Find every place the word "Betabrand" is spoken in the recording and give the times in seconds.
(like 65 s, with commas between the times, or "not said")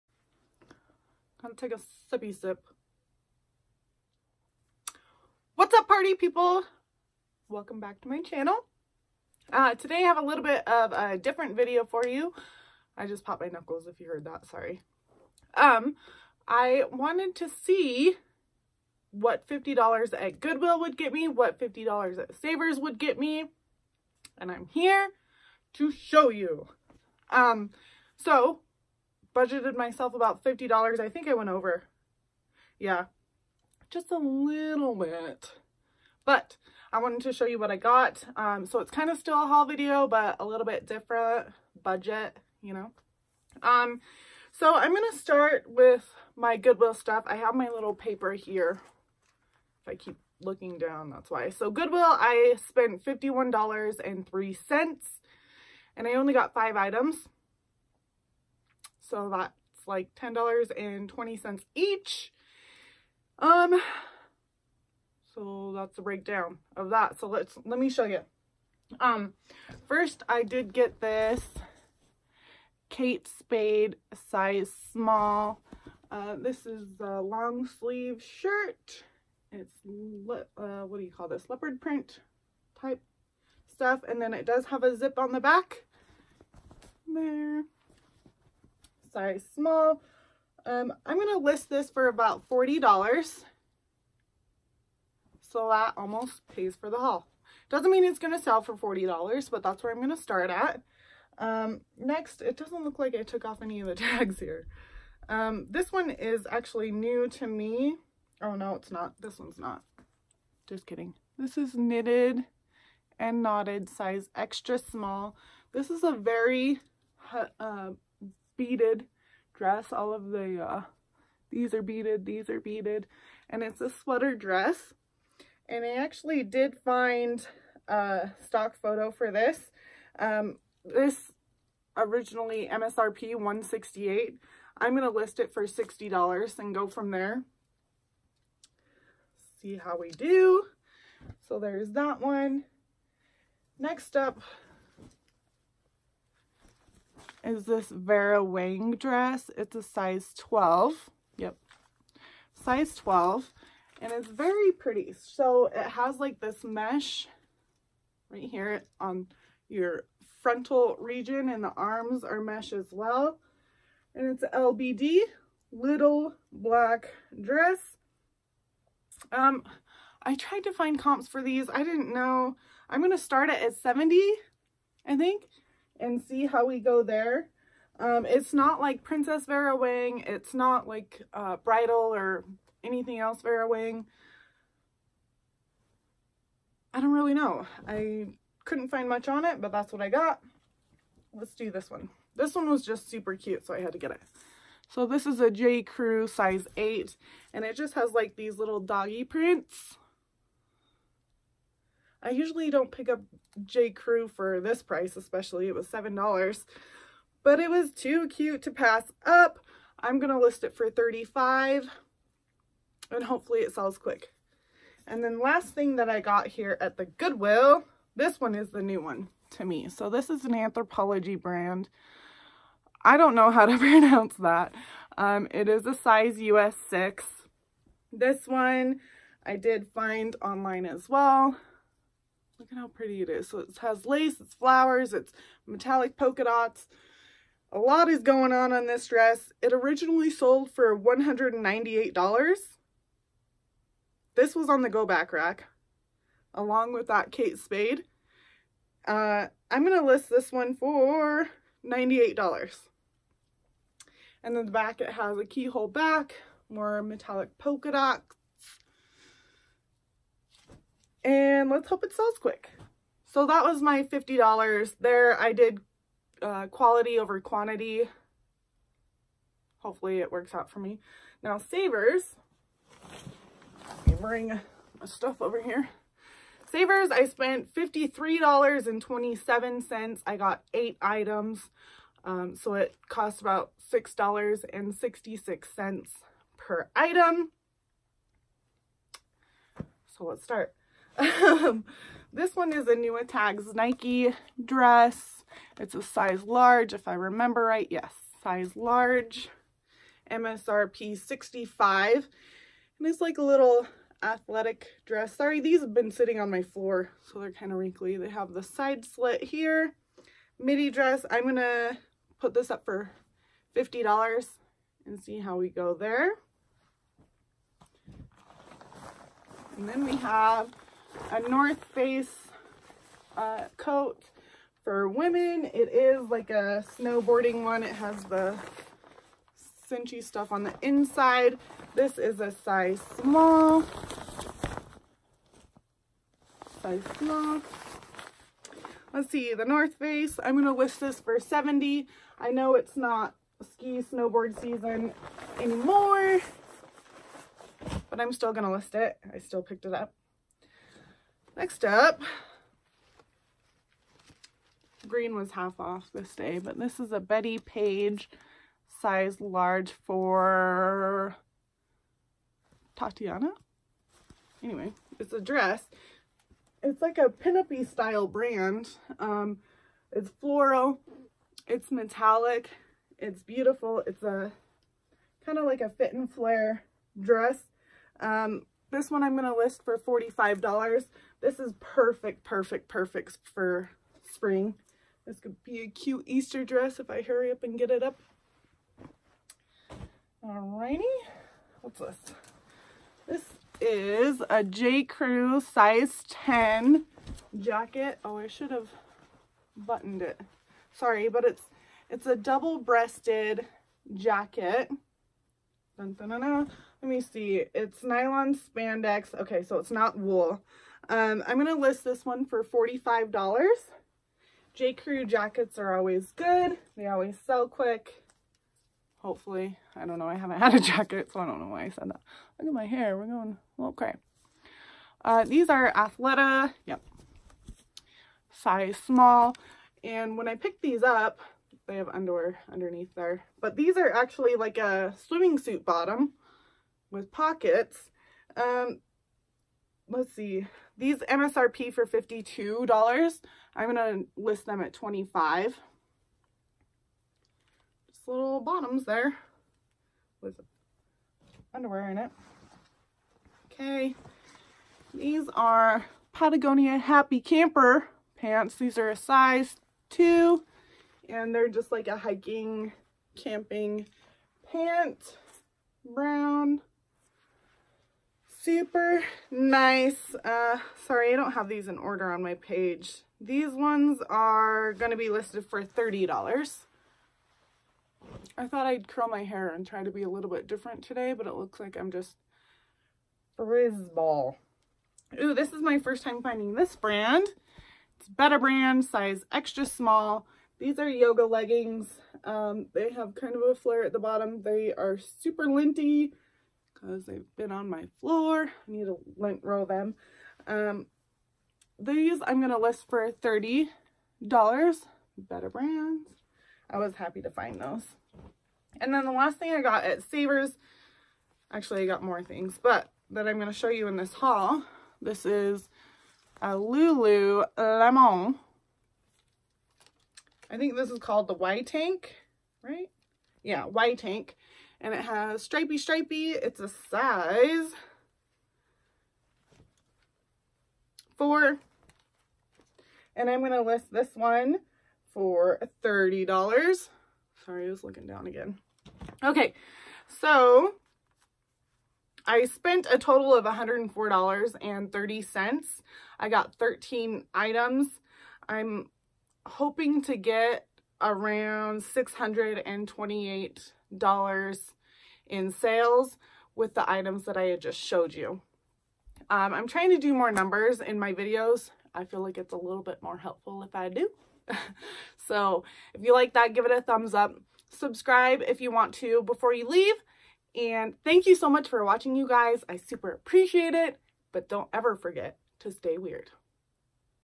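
488 s, 504 s.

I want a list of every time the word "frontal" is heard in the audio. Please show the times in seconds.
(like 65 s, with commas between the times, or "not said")
160 s.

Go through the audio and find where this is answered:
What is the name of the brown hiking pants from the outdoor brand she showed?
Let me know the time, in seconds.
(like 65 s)
456 s.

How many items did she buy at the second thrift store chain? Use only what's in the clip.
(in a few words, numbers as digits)
8.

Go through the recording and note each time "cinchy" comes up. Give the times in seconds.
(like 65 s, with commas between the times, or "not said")
329 s.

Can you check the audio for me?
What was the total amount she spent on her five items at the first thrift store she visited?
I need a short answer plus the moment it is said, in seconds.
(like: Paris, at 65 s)
$51.03, at 53 s.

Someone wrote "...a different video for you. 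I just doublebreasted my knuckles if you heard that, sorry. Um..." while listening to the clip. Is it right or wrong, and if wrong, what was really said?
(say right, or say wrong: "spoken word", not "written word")
wrong: "popped", not "doublebreasted".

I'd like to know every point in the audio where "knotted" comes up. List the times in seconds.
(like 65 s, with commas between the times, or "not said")
113 s.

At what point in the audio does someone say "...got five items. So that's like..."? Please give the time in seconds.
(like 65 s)
56 s.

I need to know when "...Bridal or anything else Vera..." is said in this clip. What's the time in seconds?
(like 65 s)
181 s.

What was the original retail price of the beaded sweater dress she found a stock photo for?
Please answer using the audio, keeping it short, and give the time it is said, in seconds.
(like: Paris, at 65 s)
168, at 132 s.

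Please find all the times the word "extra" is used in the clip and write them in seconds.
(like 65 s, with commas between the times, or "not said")
114 s, 489 s.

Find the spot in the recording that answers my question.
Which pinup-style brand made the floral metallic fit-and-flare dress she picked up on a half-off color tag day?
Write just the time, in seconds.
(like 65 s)
357 s.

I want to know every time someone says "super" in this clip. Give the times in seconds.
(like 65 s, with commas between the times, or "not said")
193 s, 468 s, 495 s, 572 s.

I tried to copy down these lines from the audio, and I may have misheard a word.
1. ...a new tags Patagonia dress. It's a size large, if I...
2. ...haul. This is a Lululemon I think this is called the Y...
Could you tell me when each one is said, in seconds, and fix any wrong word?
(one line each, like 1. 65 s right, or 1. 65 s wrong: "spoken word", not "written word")
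1. 292 s wrong: "Nike", not "Patagonia"
2. 514 s right.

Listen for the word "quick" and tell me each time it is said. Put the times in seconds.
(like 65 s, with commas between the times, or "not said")
213 s, 262 s, 417 s.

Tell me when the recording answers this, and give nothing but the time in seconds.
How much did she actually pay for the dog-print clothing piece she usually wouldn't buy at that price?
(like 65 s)
205 s.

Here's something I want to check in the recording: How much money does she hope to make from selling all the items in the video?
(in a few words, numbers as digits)
$628.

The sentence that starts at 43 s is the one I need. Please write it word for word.
Um, so I'm going to start with my Goodwill stuff.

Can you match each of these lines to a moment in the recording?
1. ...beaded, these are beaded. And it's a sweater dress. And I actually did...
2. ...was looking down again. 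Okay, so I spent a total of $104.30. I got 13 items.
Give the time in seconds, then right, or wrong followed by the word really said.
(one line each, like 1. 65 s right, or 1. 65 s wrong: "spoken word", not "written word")
1. 121 s right
2. 537 s right.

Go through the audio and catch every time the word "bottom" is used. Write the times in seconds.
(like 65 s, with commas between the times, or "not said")
435 s, 448 s, 494 s.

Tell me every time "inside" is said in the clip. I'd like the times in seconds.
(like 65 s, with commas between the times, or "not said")
330 s.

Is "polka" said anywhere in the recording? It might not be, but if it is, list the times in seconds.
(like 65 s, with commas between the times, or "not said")
236 s, 257 s.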